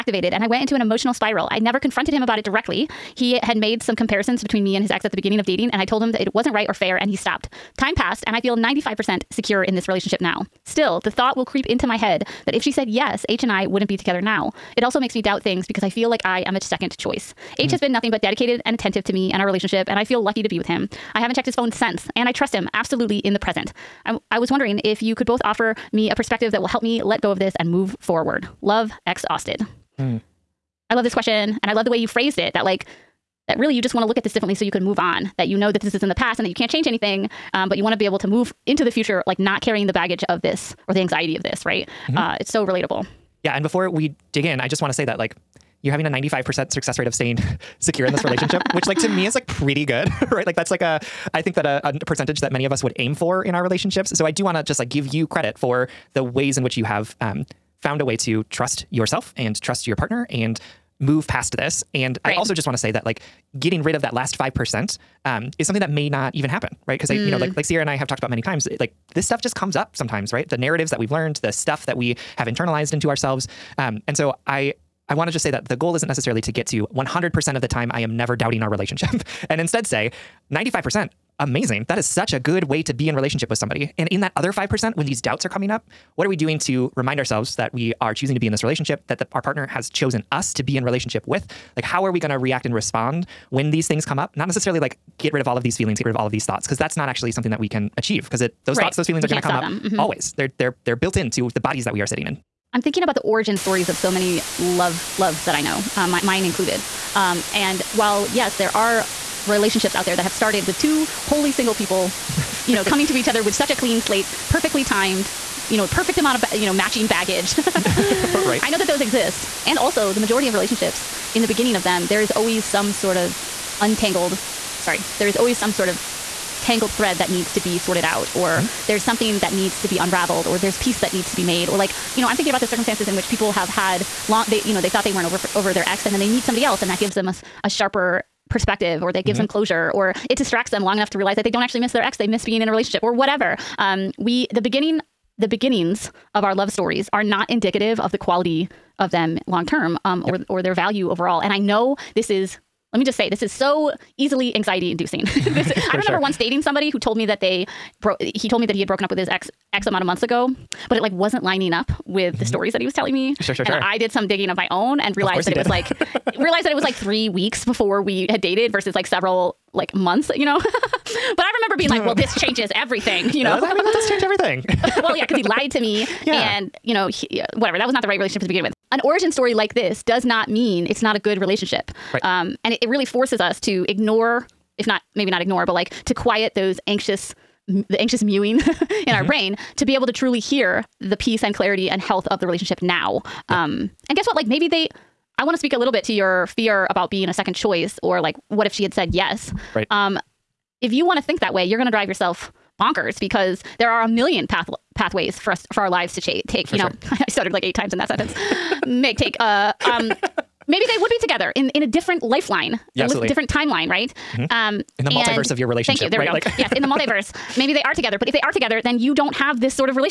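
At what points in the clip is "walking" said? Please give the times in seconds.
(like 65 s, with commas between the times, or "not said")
not said.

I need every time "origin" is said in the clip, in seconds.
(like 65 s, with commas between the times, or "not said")
103 s, 179 s.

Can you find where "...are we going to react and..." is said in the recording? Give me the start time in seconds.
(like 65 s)
92 s.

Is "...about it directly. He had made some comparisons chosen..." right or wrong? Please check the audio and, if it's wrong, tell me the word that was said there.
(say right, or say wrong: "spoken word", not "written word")
wrong: "between", not "chosen".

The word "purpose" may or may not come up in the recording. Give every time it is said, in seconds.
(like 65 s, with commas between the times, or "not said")
not said.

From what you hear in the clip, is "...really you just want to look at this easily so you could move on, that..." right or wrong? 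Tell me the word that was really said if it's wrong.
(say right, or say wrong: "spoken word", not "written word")
wrong: "differently", not "easily".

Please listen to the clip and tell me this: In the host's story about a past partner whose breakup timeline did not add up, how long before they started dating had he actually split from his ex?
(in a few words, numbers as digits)
3 weeks.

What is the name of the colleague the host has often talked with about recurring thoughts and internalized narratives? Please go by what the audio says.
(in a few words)
Sierra.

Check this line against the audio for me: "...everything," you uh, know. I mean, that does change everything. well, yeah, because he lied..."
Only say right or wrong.
right.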